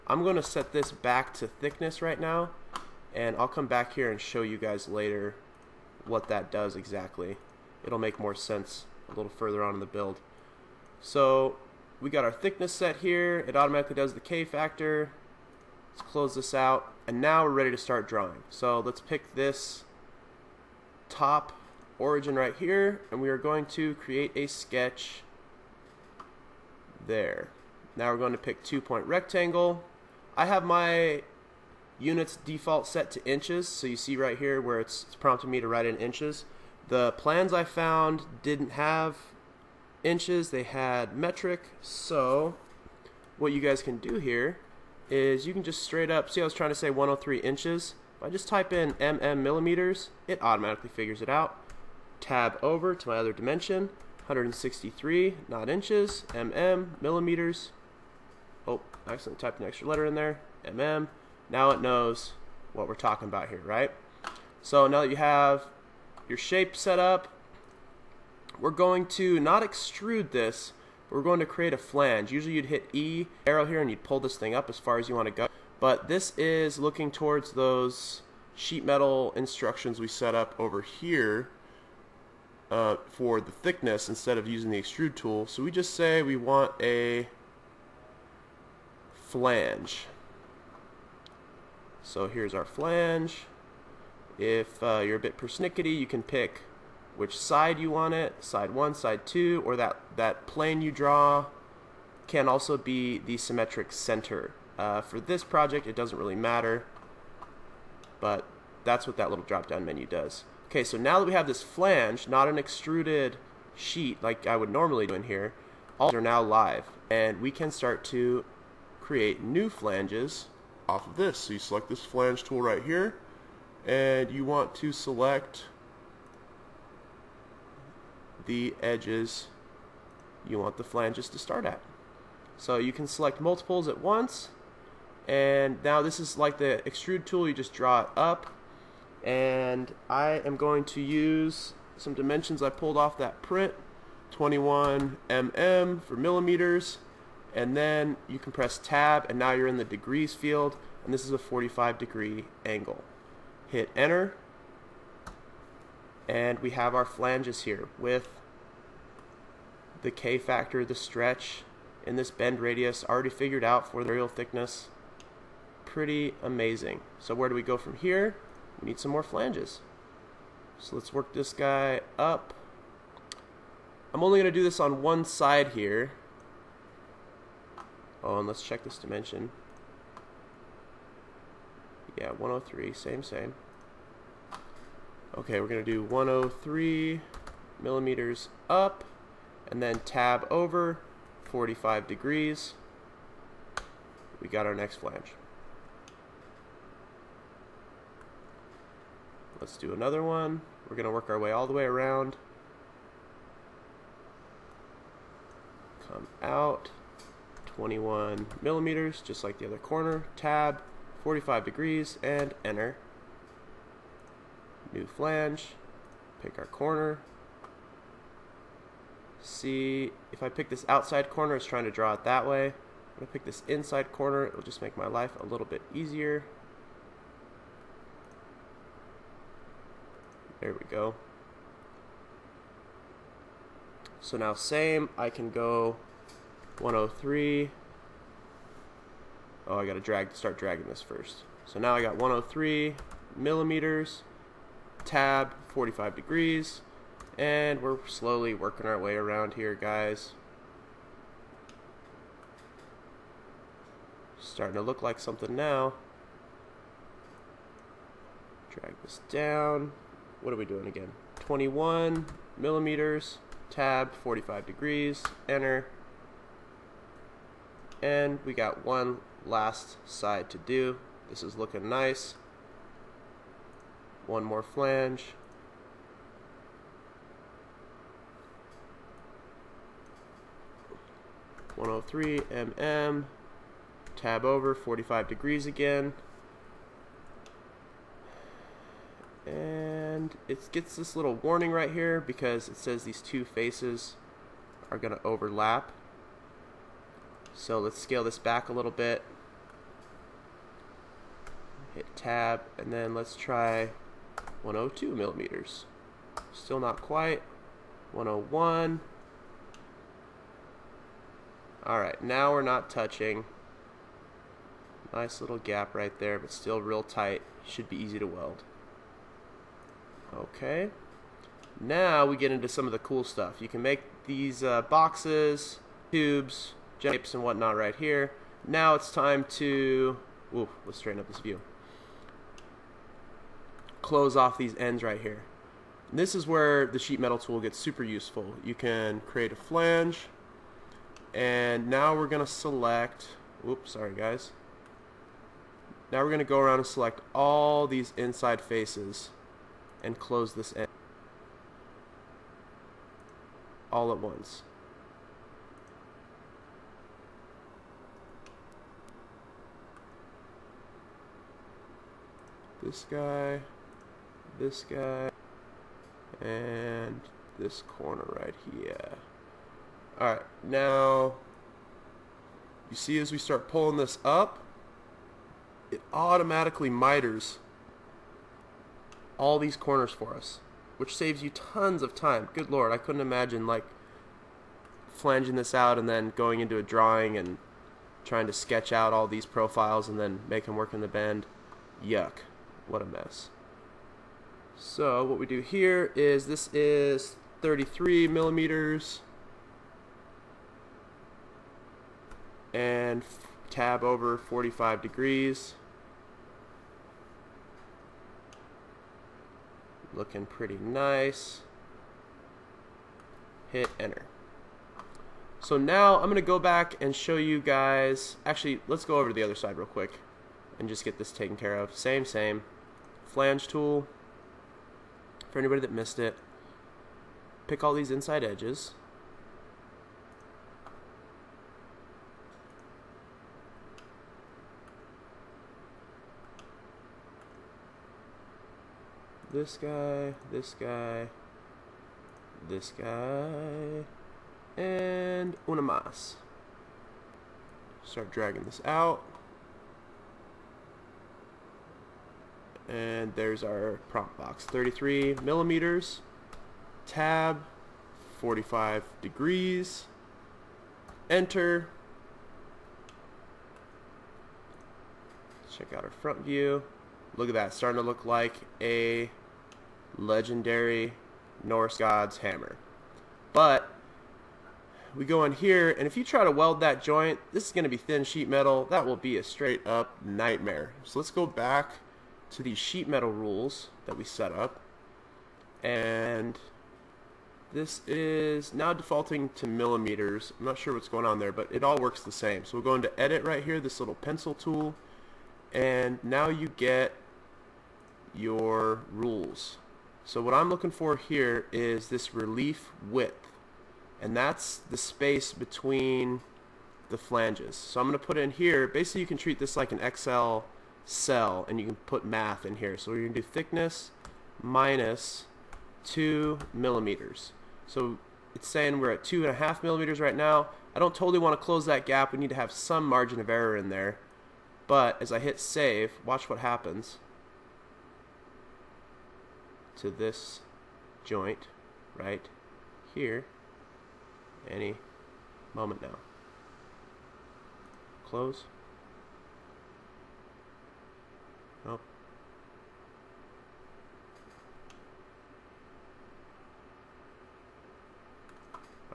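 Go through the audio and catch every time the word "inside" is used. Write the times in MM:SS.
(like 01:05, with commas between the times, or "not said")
03:43, 05:48, 07:08.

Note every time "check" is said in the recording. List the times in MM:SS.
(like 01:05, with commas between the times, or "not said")
02:58, 07:45.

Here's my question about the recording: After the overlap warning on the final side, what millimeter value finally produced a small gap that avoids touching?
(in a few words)
101.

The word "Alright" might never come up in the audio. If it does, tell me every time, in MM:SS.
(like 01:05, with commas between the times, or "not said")
05:11, 06:10.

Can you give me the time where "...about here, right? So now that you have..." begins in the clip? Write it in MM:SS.
01:03.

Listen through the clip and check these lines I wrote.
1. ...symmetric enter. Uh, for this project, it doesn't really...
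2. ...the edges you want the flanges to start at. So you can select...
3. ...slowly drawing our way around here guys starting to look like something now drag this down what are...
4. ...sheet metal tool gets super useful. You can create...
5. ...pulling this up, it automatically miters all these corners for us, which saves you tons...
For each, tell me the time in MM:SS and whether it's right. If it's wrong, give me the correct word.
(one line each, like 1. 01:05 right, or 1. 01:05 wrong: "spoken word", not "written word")
1. 01:43 wrong: "center", not "enter"
2. 02:08 right
3. 04:08 wrong: "working", not "drawing"
4. 05:36 right
5. 06:13 right.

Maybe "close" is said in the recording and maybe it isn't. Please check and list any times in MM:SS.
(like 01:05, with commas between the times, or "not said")
00:16, 05:34, 05:50, 08:41, 08:58.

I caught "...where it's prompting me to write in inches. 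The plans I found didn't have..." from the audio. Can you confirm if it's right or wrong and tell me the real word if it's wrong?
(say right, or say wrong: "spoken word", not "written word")
right.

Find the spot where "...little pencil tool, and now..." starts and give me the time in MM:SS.
08:13.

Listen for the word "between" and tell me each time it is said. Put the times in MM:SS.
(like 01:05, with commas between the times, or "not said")
08:25.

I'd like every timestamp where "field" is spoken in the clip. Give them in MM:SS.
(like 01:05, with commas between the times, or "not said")
02:30.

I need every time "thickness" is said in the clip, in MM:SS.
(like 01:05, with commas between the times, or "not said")
00:01, 00:12, 01:23, 02:44, 08:33.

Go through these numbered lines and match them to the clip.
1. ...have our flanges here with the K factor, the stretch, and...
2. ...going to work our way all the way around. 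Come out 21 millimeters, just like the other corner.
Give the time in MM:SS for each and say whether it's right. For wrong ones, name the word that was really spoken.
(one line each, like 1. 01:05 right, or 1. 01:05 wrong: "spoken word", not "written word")
1. 02:36 right
2. 03:20 right.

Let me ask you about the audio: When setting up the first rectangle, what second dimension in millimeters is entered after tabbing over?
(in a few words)
163.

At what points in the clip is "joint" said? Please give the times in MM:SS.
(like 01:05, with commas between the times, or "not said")
07:57, 08:51.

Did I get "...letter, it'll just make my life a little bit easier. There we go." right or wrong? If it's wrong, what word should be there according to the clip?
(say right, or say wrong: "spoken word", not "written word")
wrong: "corner", not "letter".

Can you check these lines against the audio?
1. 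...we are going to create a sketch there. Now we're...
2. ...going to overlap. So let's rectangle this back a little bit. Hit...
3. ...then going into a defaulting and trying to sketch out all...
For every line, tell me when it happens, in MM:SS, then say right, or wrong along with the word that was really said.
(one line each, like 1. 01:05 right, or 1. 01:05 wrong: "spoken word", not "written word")
1. 00:23 right
2. 04:54 wrong: "scale", not "rectangle"
3. 06:26 wrong: "drawing", not "defaulting".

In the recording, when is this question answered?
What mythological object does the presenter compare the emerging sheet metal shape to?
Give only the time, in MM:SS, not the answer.
07:51.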